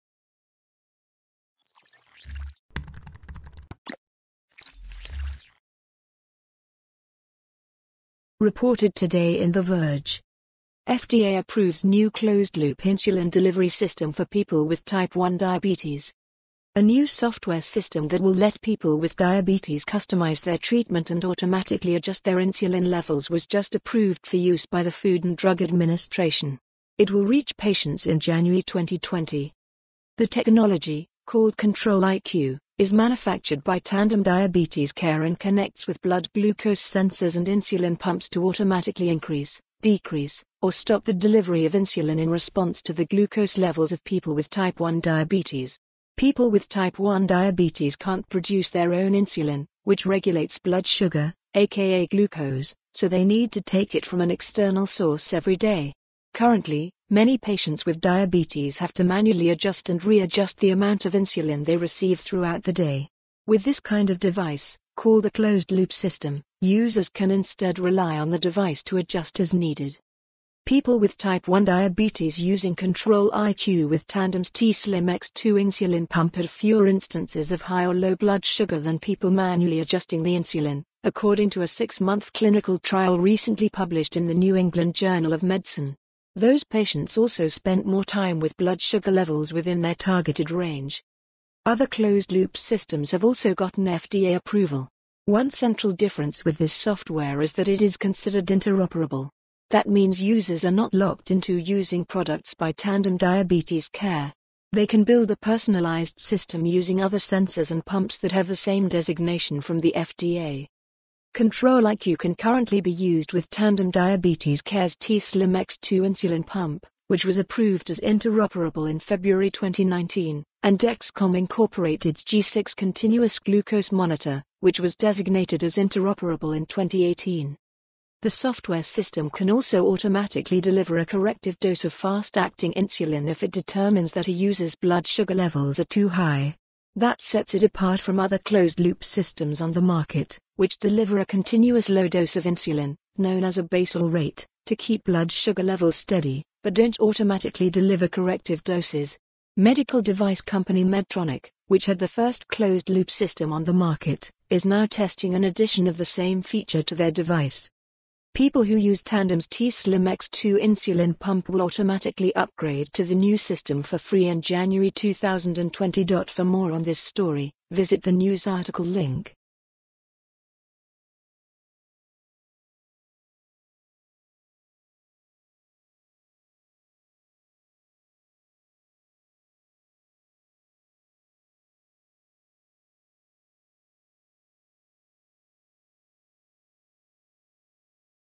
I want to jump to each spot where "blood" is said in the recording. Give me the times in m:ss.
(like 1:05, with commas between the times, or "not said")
0:36, 0:50, 1:18, 1:28, 2:14, 2:25.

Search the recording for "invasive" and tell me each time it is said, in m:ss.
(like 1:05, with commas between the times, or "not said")
not said.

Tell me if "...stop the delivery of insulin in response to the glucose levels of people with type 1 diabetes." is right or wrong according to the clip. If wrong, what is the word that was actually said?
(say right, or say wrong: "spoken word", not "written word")
right.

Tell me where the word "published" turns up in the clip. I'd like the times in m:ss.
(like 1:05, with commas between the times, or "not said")
1:23.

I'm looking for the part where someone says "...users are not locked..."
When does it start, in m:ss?
1:40.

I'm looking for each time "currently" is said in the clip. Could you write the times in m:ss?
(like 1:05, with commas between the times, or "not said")
0:56, 1:52.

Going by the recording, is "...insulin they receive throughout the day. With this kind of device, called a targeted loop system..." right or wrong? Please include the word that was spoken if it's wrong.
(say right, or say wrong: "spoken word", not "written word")
wrong: "closed", not "targeted".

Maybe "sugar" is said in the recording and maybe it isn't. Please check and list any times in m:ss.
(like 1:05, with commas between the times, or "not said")
0:50, 1:18, 1:28, 2:15, 2:25.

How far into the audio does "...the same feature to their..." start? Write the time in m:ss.
2:35.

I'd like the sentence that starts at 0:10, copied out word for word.
FDA approves new closed-loop insulin delivery system for people with type 1 diabetes.